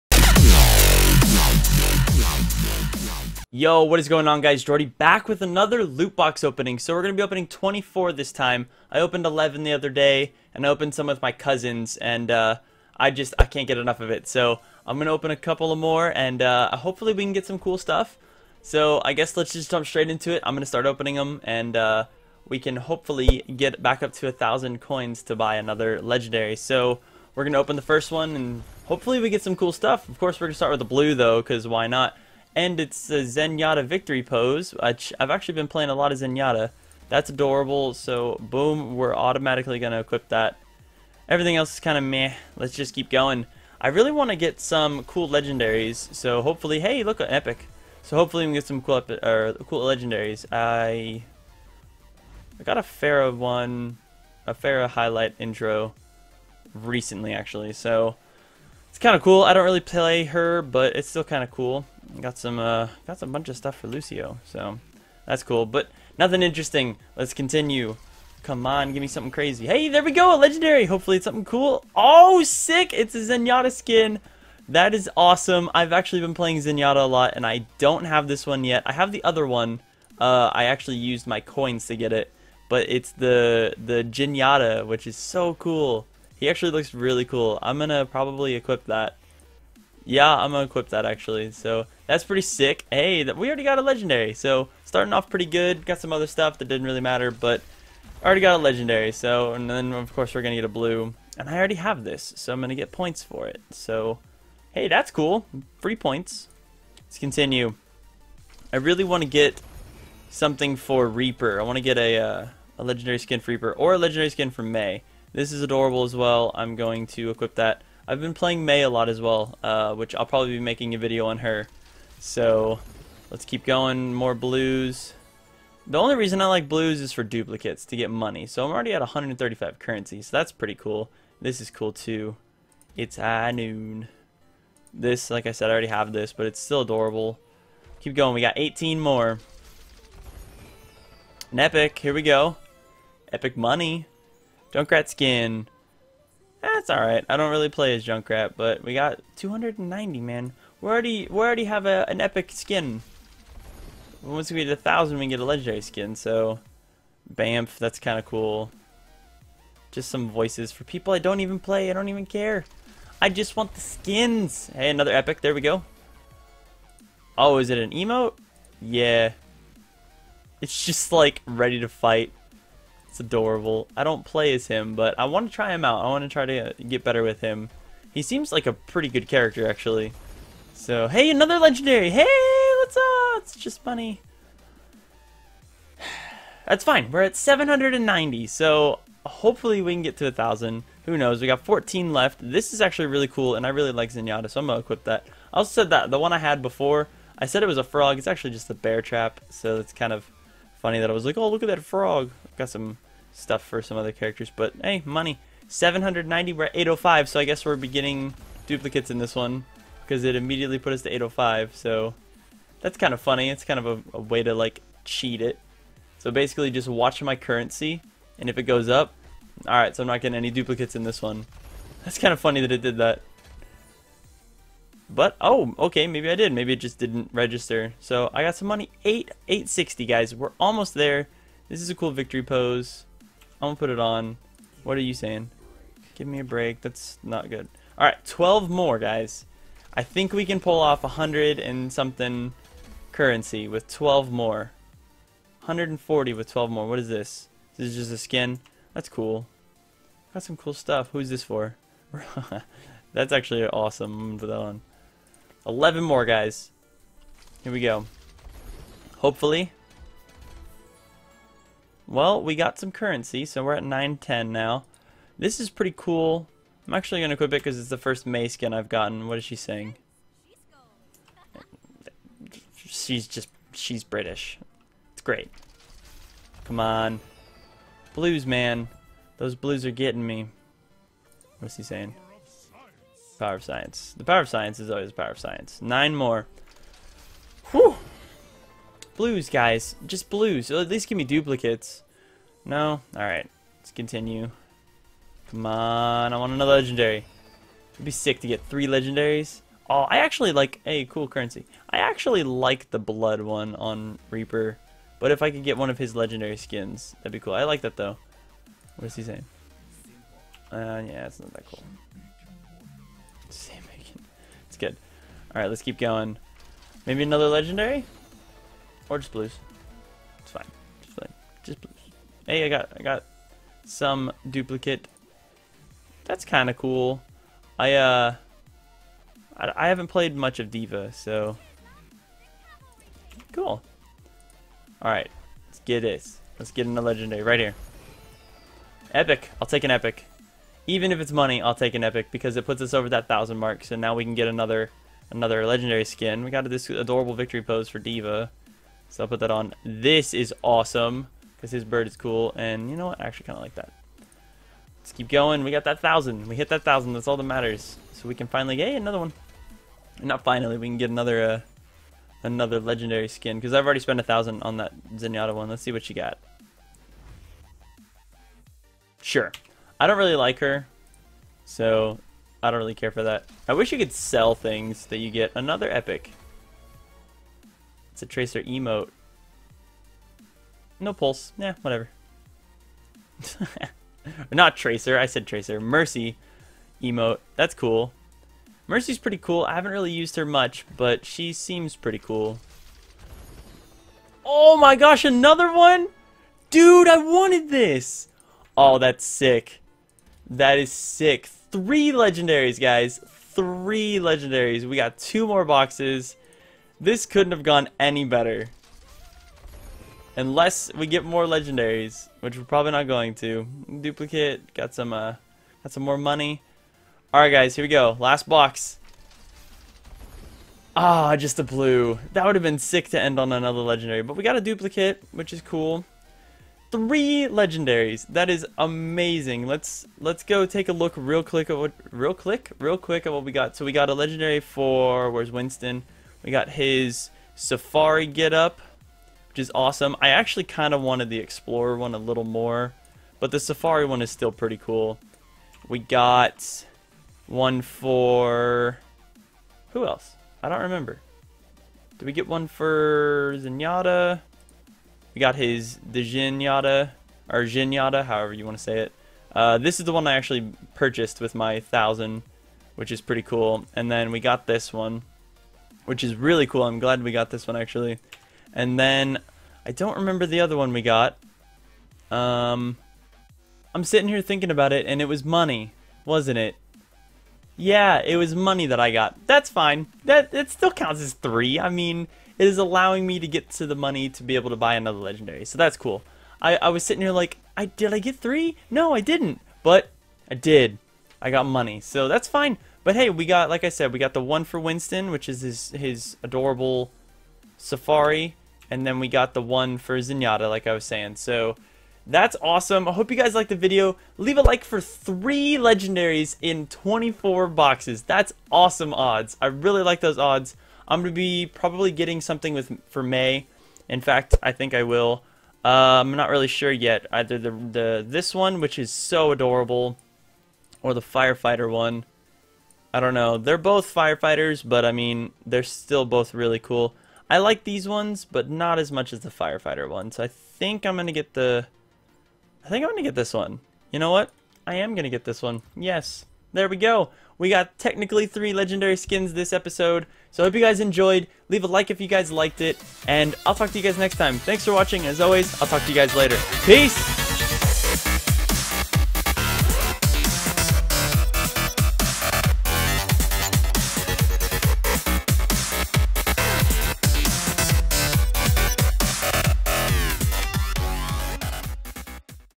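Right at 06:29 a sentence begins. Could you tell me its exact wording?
I haven't really used her much, but she seems pretty cool.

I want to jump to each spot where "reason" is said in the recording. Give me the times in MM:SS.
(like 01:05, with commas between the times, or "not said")
02:06.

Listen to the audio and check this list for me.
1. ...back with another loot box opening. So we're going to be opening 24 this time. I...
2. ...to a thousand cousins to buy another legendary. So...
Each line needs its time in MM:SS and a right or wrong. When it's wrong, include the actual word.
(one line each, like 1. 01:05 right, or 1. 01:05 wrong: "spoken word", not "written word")
1. 00:04 right
2. 00:24 wrong: "coins", not "cousins".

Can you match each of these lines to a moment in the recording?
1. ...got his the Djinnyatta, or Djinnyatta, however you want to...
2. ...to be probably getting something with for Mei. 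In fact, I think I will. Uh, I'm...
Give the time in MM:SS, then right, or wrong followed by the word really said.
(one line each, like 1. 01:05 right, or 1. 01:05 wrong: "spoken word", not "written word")
1. 07:35 right
2. 08:31 right.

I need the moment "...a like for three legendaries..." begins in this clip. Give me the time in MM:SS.
08:24.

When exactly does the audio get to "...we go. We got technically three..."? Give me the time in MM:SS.
08:56.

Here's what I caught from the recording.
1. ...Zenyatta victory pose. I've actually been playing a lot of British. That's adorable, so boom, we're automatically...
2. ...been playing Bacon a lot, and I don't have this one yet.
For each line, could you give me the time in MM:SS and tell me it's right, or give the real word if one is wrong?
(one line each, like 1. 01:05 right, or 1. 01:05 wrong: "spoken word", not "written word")
1. 00:33 wrong: "Zenyatta", not "British"
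2. 01:16 wrong: "Zenyatta", not "Bacon".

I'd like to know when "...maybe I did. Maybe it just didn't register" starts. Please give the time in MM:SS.
03:46.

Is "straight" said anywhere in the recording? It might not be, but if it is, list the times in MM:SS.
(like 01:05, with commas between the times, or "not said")
00:19.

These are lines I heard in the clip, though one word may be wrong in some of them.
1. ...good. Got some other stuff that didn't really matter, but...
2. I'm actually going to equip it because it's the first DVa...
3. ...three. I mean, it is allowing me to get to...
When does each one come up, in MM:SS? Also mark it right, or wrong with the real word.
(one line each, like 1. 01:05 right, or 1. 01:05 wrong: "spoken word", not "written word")
1. 01:35 right
2. 04:26 wrong: "Mei", not "DVa"
3. 08:01 right.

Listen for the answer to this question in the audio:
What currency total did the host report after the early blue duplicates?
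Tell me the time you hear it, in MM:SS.
02:09.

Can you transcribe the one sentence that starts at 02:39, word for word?
Just some voices for people I don't even play.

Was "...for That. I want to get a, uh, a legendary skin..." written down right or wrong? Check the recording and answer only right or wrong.
wrong.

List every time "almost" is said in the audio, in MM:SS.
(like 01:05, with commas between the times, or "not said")
03:50.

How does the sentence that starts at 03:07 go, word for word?
We're at 790, so hopefully we can get to a 1,000.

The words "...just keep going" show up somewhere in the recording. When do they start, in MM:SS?
00:42.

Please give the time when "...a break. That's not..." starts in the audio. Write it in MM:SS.
03:56.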